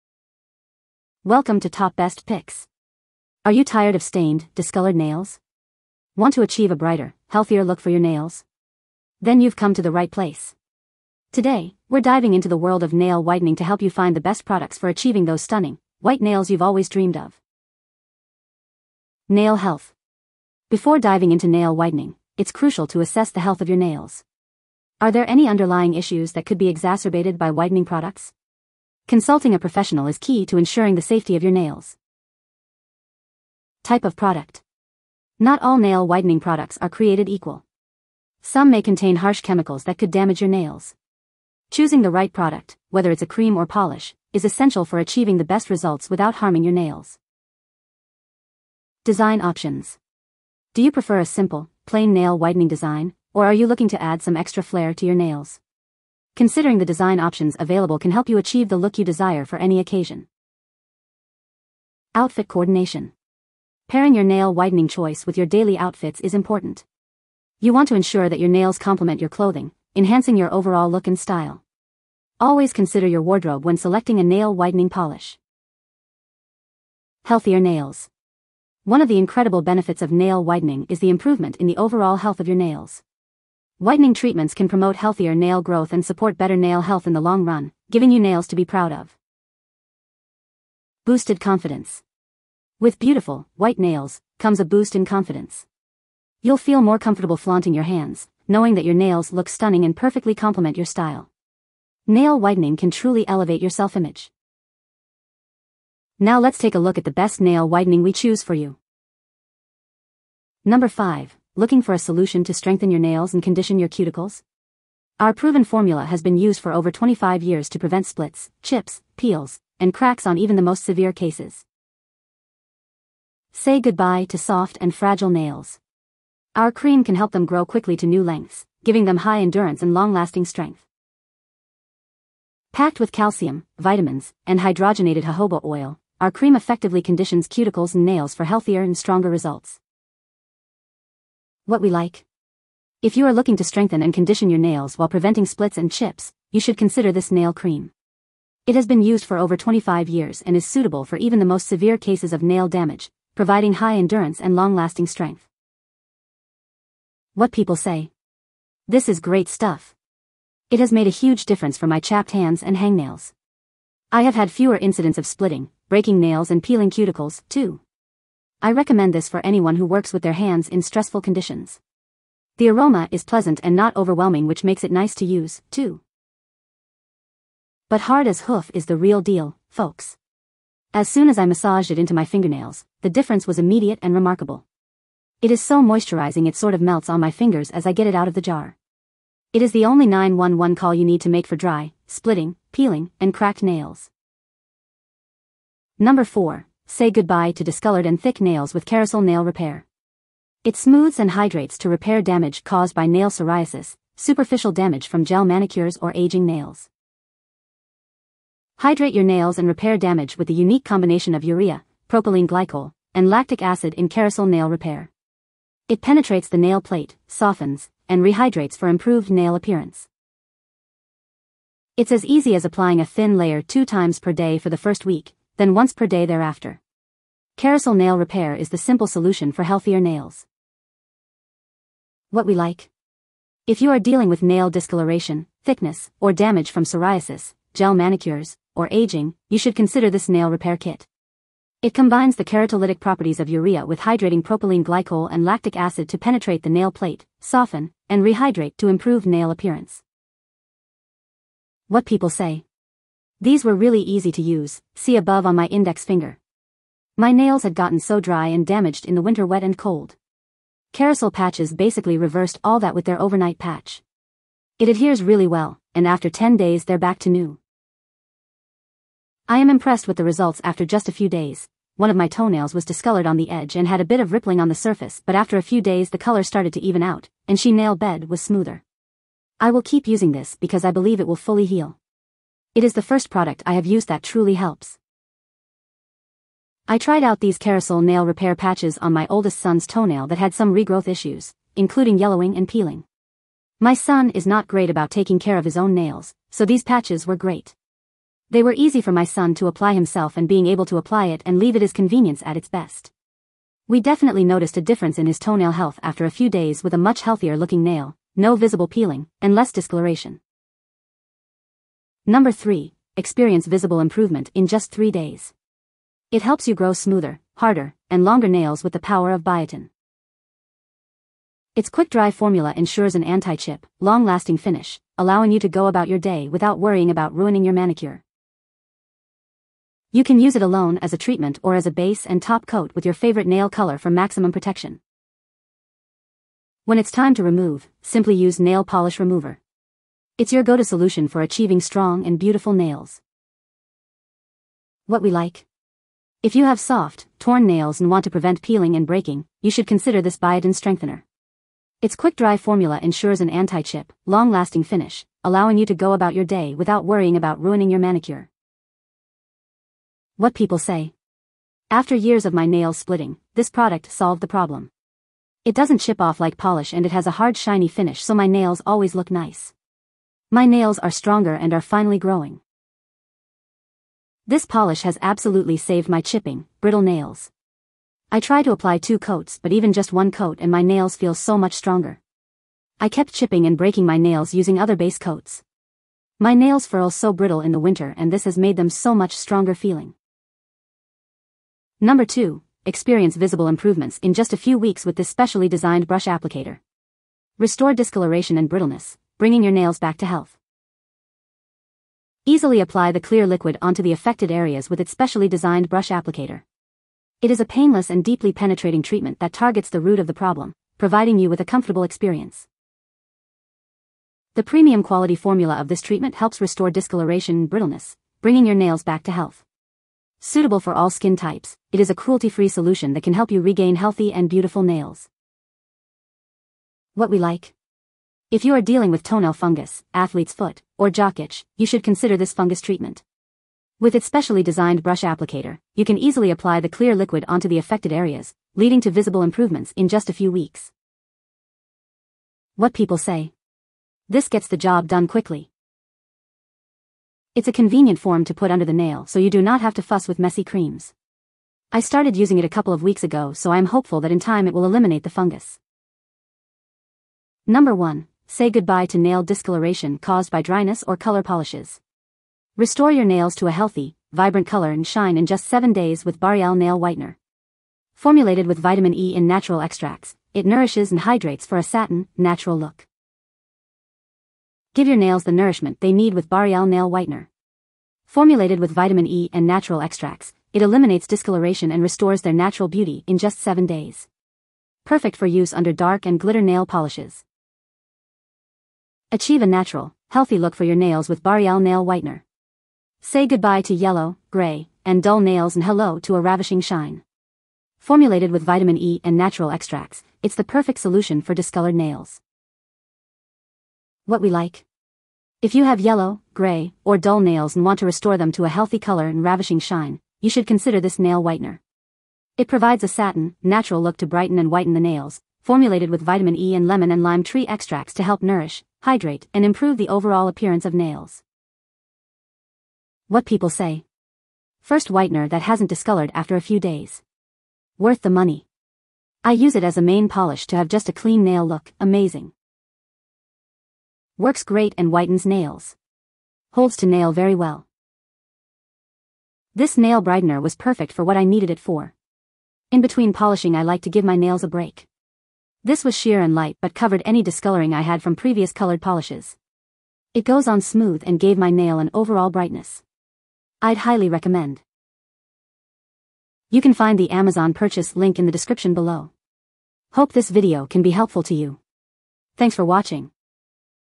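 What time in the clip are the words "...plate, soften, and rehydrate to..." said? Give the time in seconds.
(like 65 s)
246 s.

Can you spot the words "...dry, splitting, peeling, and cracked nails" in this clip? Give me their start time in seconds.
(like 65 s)
191 s.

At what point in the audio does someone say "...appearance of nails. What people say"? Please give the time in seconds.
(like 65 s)
520 s.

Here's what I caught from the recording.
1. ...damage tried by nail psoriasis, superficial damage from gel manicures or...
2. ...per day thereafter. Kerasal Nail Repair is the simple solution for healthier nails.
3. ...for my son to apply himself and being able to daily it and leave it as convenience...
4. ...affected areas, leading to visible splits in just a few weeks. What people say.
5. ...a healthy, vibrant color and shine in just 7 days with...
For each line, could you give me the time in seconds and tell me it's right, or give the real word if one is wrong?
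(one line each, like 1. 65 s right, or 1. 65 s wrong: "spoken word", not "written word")
1. 202 s wrong: "caused", not "tried"
2. 225 s right
3. 298 s wrong: "apply", not "daily"
4. 437 s wrong: "improvements", not "splits"
5. 463 s right.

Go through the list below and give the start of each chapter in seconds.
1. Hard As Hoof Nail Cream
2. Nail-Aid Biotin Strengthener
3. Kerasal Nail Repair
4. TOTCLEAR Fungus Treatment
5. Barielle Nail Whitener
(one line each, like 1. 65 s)
1. 109 s
2. 311 s
3. 194 s
4. 390 s
5. 456 s.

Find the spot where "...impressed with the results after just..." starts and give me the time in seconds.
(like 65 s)
269 s.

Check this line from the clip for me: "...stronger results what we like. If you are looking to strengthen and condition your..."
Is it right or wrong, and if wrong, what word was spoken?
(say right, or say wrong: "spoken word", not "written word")
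right.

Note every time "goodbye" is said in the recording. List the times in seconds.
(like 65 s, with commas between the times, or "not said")
123 s, 197 s, 458 s, 493 s.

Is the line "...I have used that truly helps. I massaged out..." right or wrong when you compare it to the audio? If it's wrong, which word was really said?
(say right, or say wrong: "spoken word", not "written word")
wrong: "tried", not "massaged".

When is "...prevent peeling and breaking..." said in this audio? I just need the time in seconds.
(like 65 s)
348 s.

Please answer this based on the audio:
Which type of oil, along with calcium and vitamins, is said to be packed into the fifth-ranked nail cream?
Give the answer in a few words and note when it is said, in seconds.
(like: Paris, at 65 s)
hydrogenated jojoba oil, at 134 s.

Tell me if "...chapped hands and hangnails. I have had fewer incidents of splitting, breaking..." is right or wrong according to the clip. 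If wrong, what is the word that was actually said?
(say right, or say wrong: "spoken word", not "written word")
right.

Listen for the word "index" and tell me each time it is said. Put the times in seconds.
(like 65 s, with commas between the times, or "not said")
255 s.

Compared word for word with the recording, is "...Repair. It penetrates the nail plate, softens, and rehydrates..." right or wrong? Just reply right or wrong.
right.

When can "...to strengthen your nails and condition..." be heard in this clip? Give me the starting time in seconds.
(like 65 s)
112 s.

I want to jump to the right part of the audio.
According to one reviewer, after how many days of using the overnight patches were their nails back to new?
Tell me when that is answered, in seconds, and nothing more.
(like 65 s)
266 s.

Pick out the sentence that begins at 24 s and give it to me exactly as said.
Are there any underlying issues that could be exacerbated by whitening products?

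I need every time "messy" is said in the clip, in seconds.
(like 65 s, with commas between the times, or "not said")
450 s.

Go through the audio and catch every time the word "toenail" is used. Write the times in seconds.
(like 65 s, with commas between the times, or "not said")
272 s, 289 s, 305 s, 429 s.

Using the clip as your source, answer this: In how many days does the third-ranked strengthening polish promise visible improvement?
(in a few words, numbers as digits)
3.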